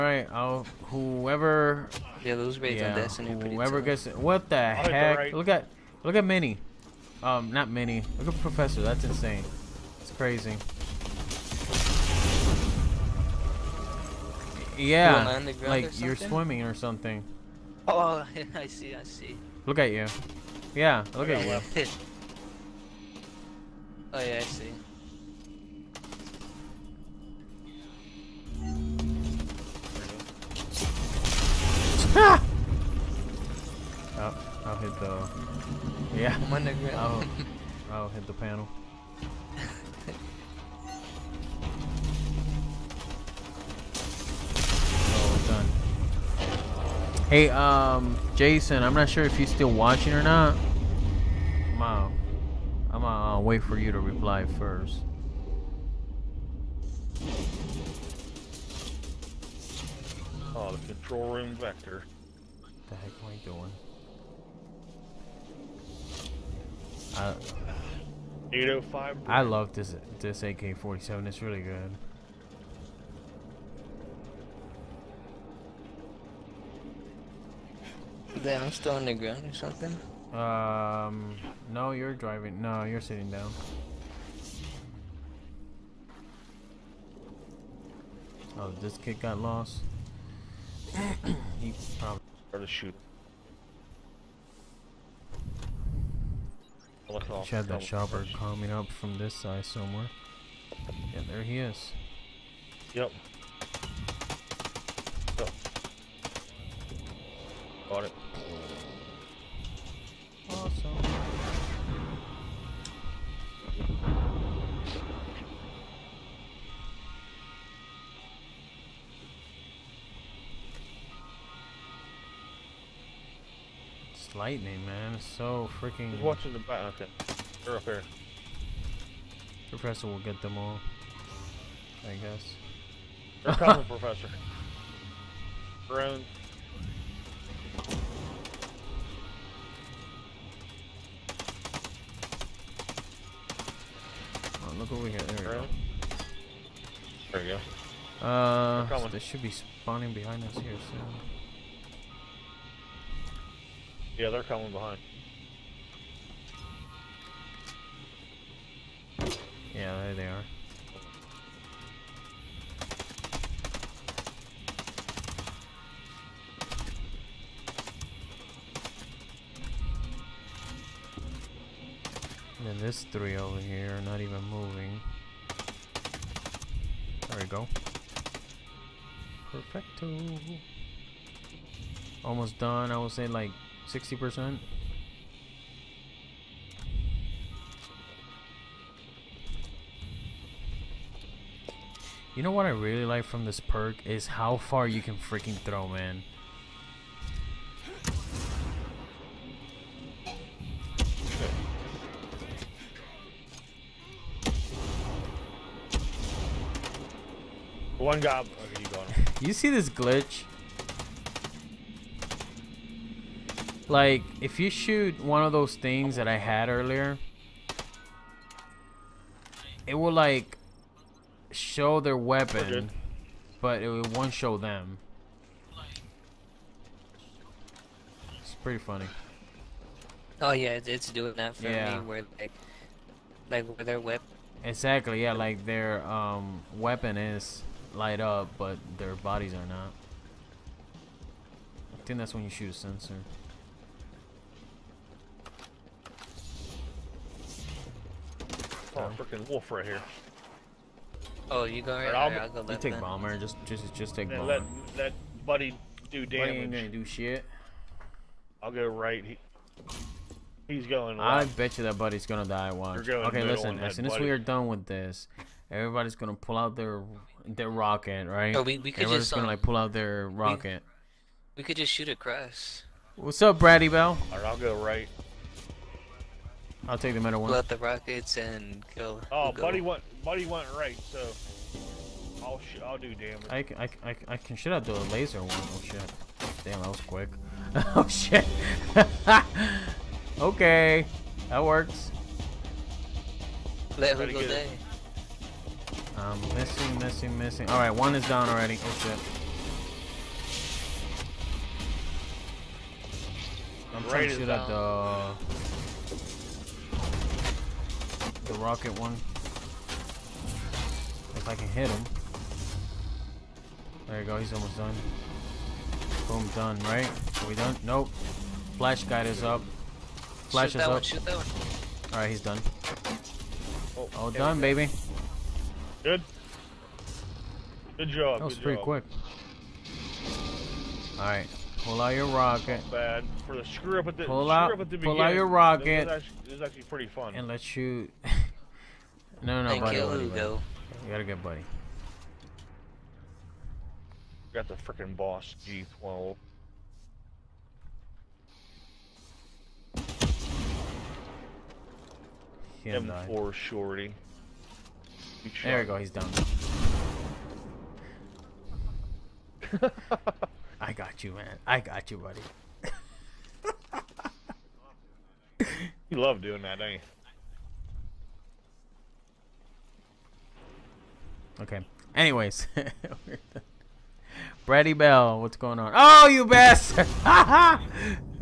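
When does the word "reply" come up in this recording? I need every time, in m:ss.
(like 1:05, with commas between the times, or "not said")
0:53.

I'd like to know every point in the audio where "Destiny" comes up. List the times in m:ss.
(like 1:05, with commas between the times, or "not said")
0:02.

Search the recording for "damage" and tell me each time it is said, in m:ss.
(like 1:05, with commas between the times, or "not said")
4:16, 4:43.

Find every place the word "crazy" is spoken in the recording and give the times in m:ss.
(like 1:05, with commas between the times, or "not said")
0:10.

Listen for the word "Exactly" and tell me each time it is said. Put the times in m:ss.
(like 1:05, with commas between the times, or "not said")
3:54.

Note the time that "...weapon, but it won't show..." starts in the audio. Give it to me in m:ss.
3:42.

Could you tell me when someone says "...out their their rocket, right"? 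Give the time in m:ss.
4:26.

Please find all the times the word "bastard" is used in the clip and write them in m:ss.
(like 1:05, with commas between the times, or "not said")
6:16.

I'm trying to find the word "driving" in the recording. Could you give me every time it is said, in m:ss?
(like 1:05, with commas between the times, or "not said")
1:22.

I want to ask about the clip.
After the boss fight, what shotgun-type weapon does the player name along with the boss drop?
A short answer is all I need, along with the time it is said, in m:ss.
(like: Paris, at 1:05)
M4 shorty, at 5:52.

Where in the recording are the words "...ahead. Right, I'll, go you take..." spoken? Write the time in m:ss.
4:11.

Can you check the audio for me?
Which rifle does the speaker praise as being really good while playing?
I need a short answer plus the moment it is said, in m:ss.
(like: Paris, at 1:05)
AK-47, at 1:10.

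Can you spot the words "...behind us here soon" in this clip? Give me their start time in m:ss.
2:30.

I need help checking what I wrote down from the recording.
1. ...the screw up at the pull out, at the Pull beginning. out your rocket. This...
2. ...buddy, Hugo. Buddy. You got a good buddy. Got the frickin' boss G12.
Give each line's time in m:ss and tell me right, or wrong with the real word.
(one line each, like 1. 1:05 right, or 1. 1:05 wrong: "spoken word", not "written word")
1. 5:33 right
2. 5:40 right.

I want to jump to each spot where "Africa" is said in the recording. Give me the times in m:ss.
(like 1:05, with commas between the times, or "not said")
not said.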